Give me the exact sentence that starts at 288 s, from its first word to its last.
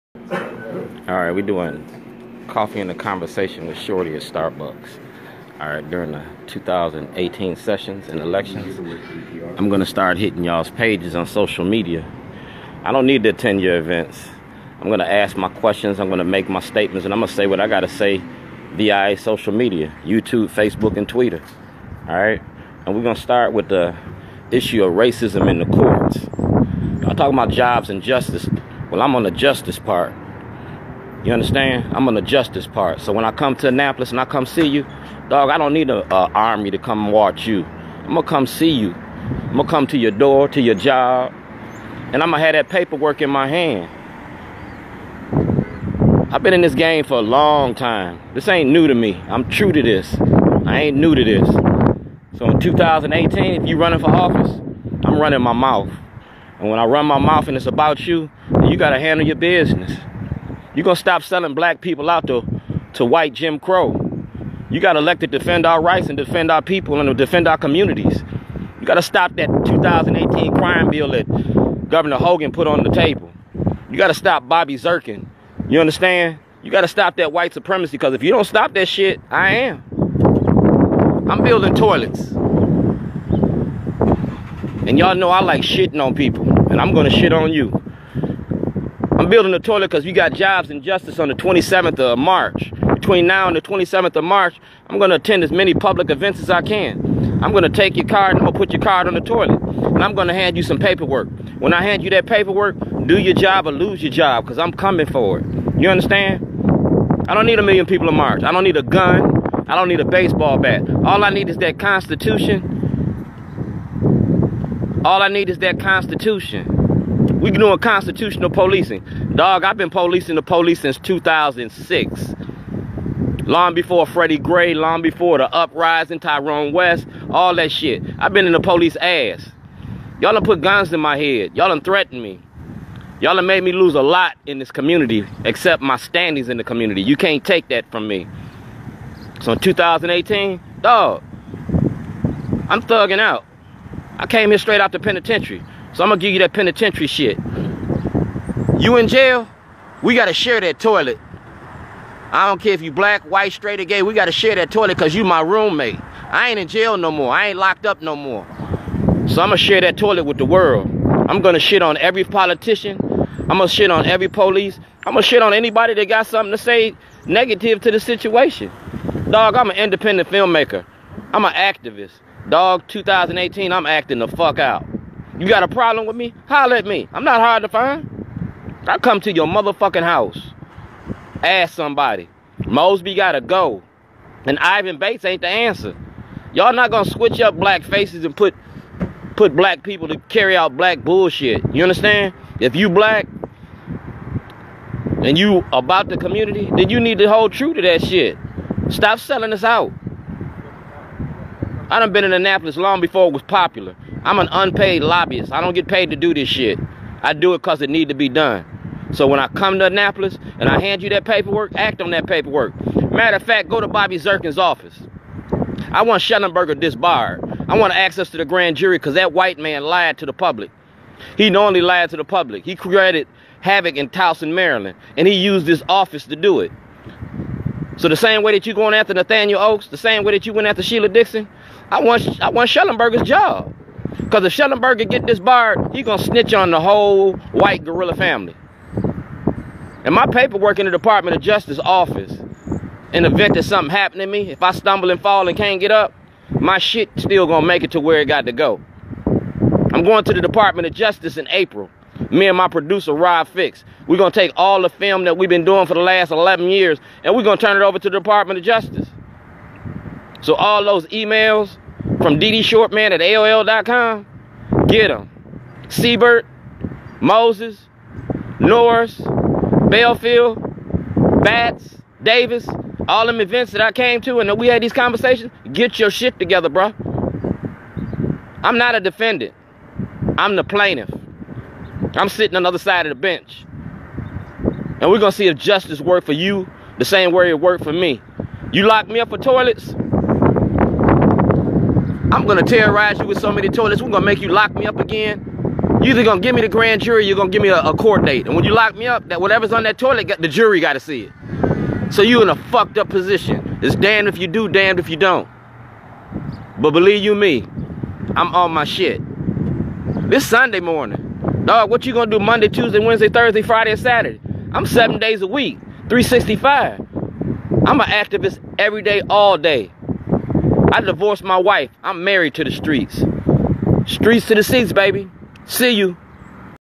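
You locked me up for toilets, I'm gonna terrorize you with so many toilets, we're gonna make you lock me up again.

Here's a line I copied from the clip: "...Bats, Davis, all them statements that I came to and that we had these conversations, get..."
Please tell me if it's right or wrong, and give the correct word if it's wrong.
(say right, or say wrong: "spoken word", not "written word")
wrong: "events", not "statements".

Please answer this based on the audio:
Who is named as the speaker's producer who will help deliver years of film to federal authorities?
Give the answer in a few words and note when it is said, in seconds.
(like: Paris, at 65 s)
Rob Fix, at 253 s.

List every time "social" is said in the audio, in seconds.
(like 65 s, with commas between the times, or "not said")
11 s, 19 s.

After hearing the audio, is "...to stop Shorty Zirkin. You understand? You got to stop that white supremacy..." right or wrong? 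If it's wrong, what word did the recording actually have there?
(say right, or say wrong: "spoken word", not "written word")
wrong: "Bobby", not "Shorty".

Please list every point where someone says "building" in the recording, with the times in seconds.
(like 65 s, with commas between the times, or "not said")
81 s, 89 s.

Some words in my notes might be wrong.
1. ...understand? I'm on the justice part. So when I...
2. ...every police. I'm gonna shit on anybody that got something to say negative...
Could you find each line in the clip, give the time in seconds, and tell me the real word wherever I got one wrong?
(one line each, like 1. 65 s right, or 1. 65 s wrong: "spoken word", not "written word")
1. 31 s right
2. 164 s right.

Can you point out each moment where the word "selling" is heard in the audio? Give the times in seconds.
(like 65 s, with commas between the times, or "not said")
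61 s, 199 s.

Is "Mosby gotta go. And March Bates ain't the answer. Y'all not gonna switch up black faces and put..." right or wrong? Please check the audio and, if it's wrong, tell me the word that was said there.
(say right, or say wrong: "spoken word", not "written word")
wrong: "Ivan", not "March".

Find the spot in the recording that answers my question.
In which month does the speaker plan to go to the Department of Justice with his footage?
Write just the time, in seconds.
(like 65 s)
251 s.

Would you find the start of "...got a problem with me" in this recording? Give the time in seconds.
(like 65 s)
175 s.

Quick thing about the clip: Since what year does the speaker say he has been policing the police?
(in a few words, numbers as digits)
2006.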